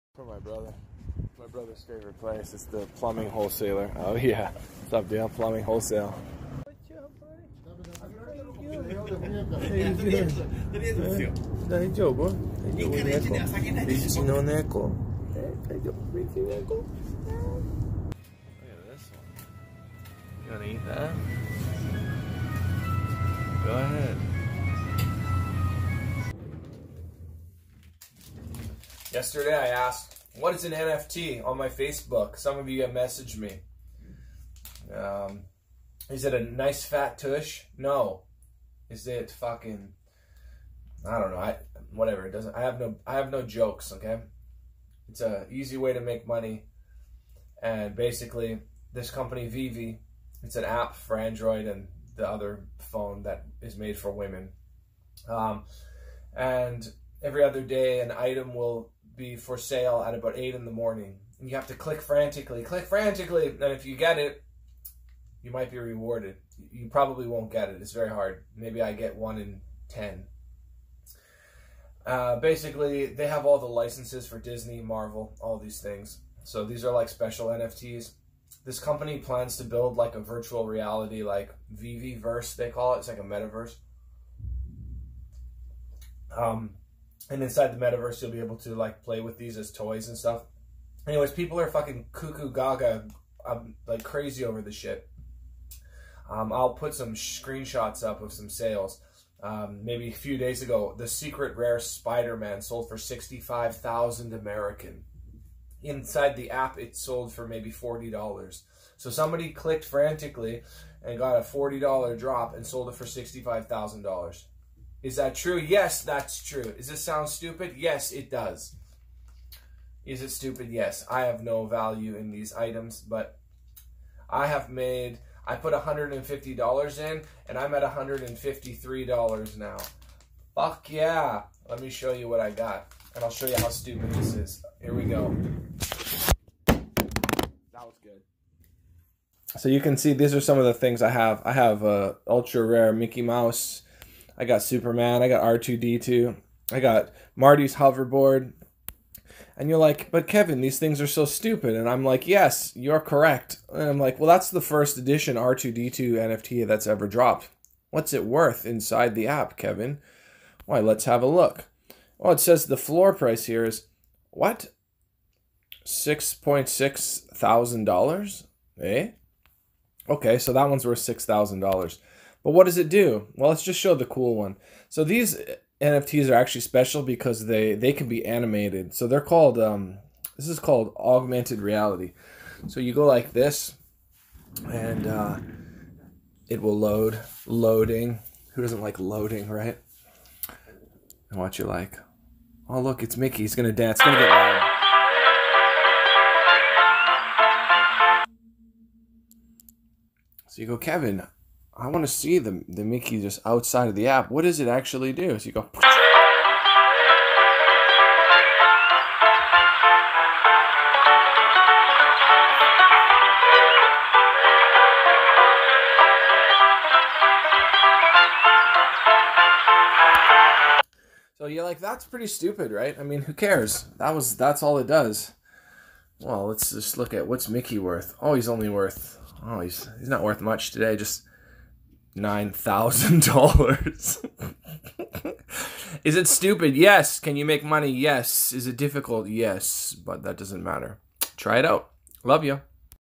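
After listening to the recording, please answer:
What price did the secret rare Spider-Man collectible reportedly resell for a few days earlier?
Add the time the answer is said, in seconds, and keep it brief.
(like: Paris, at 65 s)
$65,000, at 102 s.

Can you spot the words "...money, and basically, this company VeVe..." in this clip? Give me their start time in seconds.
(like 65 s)
46 s.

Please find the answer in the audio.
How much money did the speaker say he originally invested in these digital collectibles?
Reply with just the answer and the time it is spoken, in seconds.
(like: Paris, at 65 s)
$150, at 125 s.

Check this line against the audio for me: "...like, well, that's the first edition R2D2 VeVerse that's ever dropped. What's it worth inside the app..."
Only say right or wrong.
wrong.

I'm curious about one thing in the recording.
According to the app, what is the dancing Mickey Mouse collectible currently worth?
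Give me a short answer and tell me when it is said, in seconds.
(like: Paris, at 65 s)
$9,000, at 232 s.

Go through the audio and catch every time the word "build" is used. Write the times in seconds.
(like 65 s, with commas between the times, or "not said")
79 s.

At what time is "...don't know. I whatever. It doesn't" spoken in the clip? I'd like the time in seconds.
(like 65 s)
41 s.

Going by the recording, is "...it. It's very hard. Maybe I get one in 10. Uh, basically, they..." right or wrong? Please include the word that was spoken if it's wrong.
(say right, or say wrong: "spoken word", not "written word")
right.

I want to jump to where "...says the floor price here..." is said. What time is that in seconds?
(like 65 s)
162 s.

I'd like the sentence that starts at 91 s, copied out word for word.
Anyways, people are fucking cuckoo gaga, um, like crazy over the shit.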